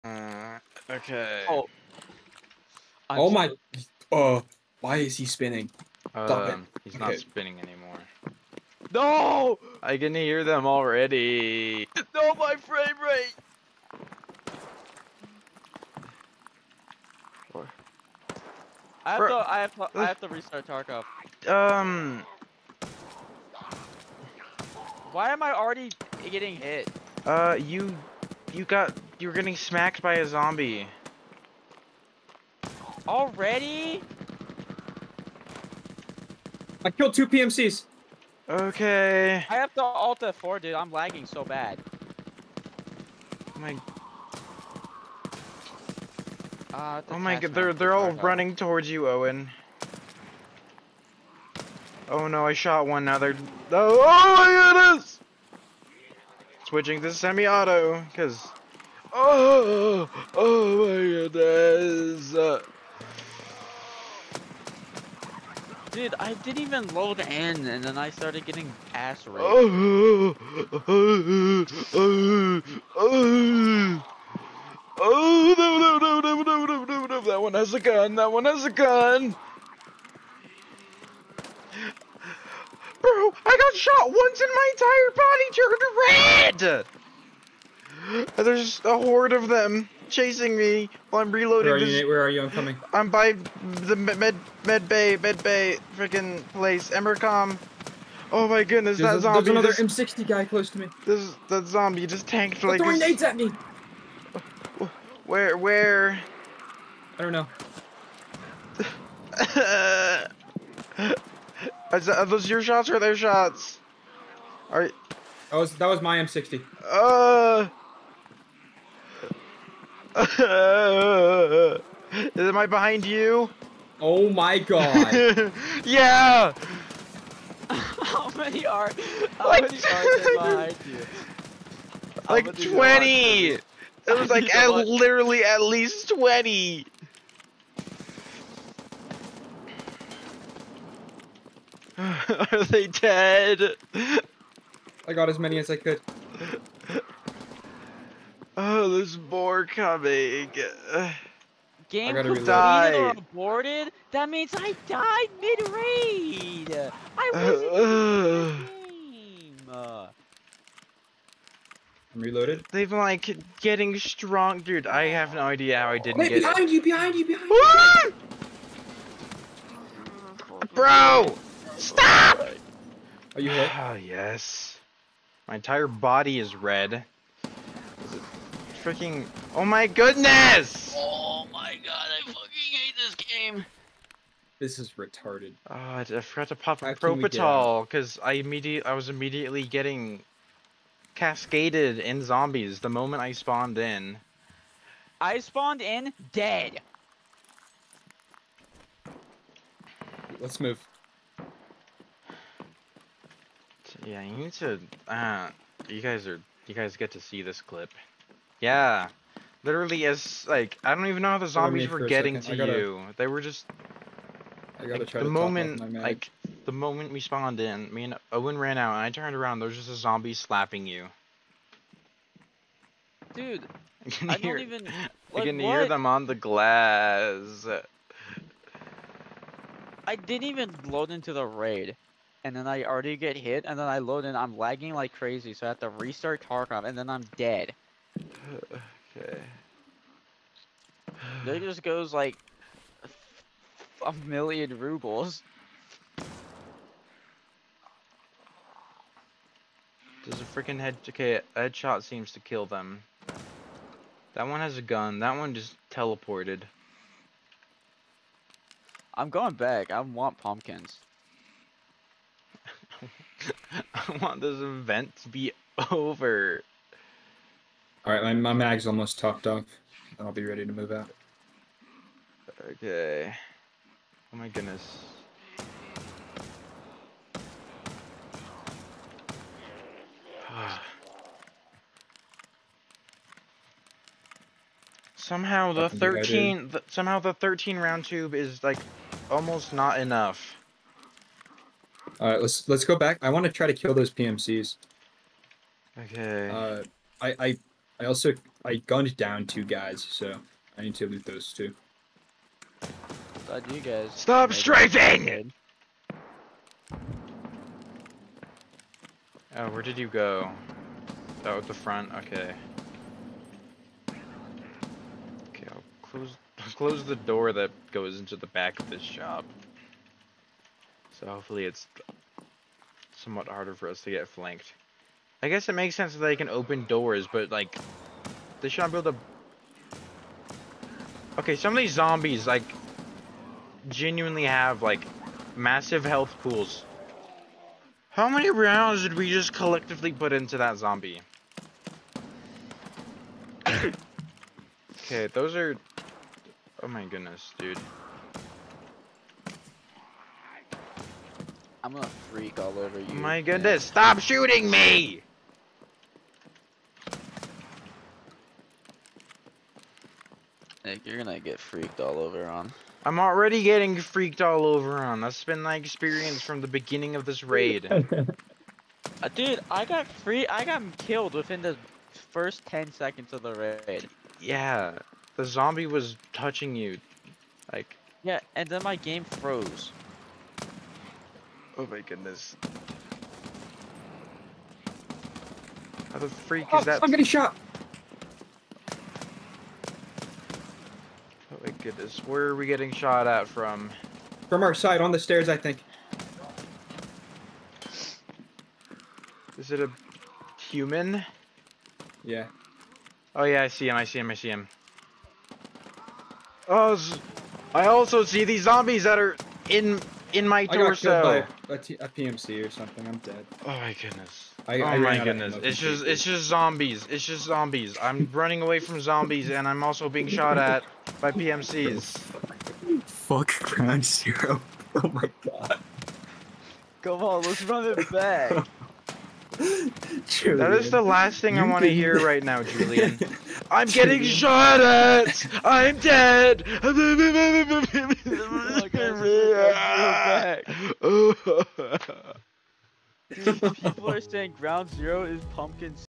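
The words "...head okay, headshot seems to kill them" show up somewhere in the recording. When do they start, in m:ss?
4:10.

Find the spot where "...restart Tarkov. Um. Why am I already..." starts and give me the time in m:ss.
0:20.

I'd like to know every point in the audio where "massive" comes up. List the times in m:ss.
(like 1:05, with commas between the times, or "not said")
5:35.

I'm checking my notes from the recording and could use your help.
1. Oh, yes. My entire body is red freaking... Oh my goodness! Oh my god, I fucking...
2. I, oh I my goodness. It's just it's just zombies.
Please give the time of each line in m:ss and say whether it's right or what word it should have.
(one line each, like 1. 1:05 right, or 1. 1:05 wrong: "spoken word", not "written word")
1. 2:53 right
2. 6:54 right.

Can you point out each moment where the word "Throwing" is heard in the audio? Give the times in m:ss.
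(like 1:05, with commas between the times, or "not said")
1:42.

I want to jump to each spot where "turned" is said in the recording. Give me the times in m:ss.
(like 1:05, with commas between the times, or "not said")
1:26, 3:39.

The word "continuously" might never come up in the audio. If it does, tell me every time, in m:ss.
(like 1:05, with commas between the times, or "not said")
not said.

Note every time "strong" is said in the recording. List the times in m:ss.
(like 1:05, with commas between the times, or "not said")
2:43.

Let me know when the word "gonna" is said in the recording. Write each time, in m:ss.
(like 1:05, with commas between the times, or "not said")
5:51, 6:01.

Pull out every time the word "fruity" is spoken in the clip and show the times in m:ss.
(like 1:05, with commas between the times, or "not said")
not said.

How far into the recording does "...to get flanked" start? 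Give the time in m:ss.
5:24.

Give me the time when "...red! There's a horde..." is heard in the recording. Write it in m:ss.
1:26.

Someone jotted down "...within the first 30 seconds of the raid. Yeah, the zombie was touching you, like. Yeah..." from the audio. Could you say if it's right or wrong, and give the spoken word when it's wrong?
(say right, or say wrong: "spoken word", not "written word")
wrong: "10", not "30".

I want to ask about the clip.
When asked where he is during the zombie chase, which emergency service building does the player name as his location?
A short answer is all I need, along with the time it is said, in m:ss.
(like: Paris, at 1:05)
EMERCOM, at 1:36.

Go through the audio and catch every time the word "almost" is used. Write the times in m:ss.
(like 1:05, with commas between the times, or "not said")
4:28, 4:49.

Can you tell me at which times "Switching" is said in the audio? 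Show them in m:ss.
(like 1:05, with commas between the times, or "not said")
0:56.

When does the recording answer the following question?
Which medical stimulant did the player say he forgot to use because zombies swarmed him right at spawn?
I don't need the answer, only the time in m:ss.
3:06.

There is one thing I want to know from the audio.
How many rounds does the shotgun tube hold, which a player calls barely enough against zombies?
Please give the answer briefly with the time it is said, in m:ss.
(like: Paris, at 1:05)
13, at 4:47.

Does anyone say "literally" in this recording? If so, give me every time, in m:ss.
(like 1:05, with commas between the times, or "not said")
2:14, 3:29.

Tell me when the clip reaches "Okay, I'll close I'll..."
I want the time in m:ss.
5:15.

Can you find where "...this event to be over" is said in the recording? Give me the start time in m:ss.
4:24.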